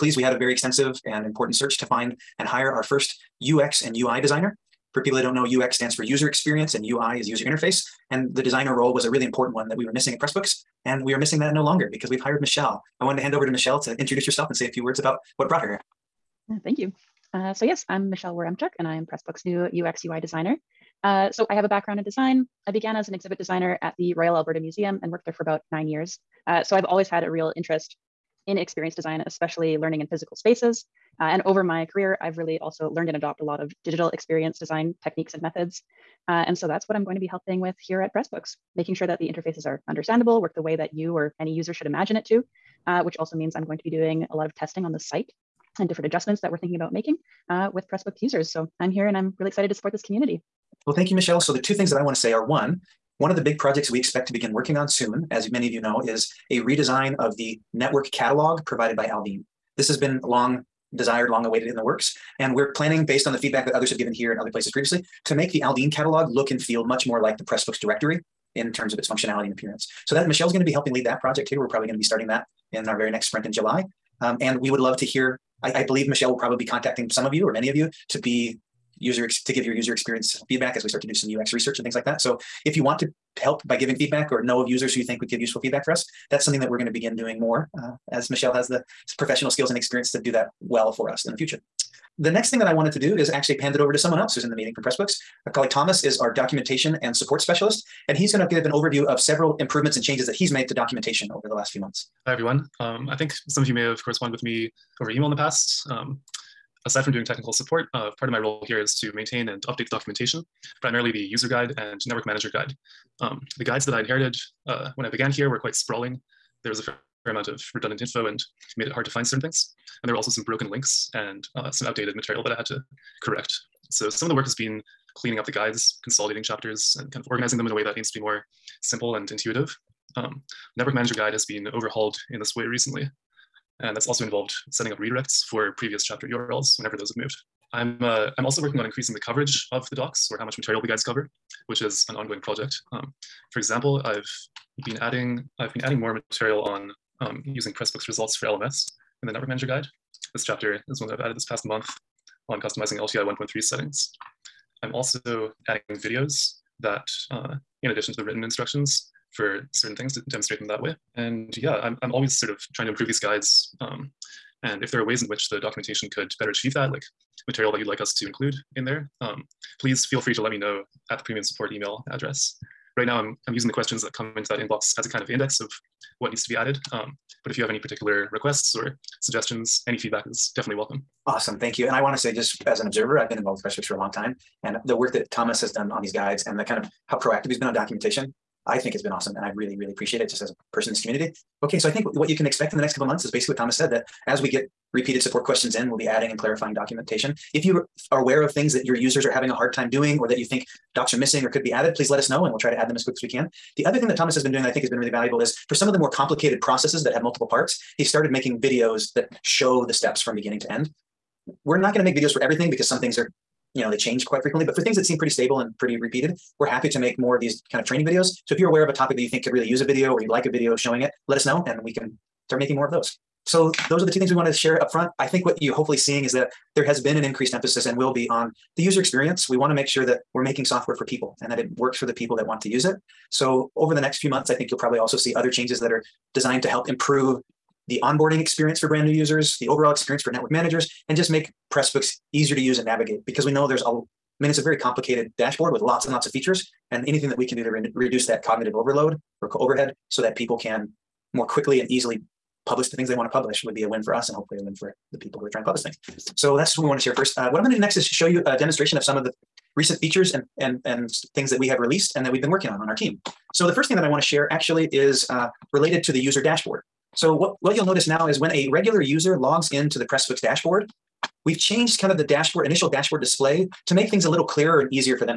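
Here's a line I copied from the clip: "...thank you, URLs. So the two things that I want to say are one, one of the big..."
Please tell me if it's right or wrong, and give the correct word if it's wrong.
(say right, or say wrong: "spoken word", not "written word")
wrong: "Michelle", not "URLs".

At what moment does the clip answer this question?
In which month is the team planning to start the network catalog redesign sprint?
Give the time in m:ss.
1:13.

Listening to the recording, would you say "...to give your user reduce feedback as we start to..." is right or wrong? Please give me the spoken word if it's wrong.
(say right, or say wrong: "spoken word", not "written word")
wrong: "experience", not "reduce".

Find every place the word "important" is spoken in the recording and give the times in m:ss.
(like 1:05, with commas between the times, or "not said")
0:01, 0:09.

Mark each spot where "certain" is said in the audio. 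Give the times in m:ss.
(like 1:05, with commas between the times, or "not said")
1:59, 2:39.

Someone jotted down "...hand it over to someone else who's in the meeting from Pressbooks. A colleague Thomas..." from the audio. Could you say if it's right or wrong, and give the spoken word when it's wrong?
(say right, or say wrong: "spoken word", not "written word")
right.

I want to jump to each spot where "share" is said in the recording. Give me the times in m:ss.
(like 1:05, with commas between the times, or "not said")
3:44, 4:17, 4:24.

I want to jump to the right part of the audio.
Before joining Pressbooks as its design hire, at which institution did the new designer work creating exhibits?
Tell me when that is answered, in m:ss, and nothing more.
0:24.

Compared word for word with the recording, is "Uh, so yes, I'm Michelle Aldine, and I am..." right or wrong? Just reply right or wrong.
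wrong.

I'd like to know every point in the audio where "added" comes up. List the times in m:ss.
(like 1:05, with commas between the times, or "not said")
2:31, 2:56, 3:21.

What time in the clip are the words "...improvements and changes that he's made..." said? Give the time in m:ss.
1:39.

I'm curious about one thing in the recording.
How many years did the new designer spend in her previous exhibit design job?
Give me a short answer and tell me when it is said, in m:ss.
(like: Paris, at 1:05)
9, at 0:25.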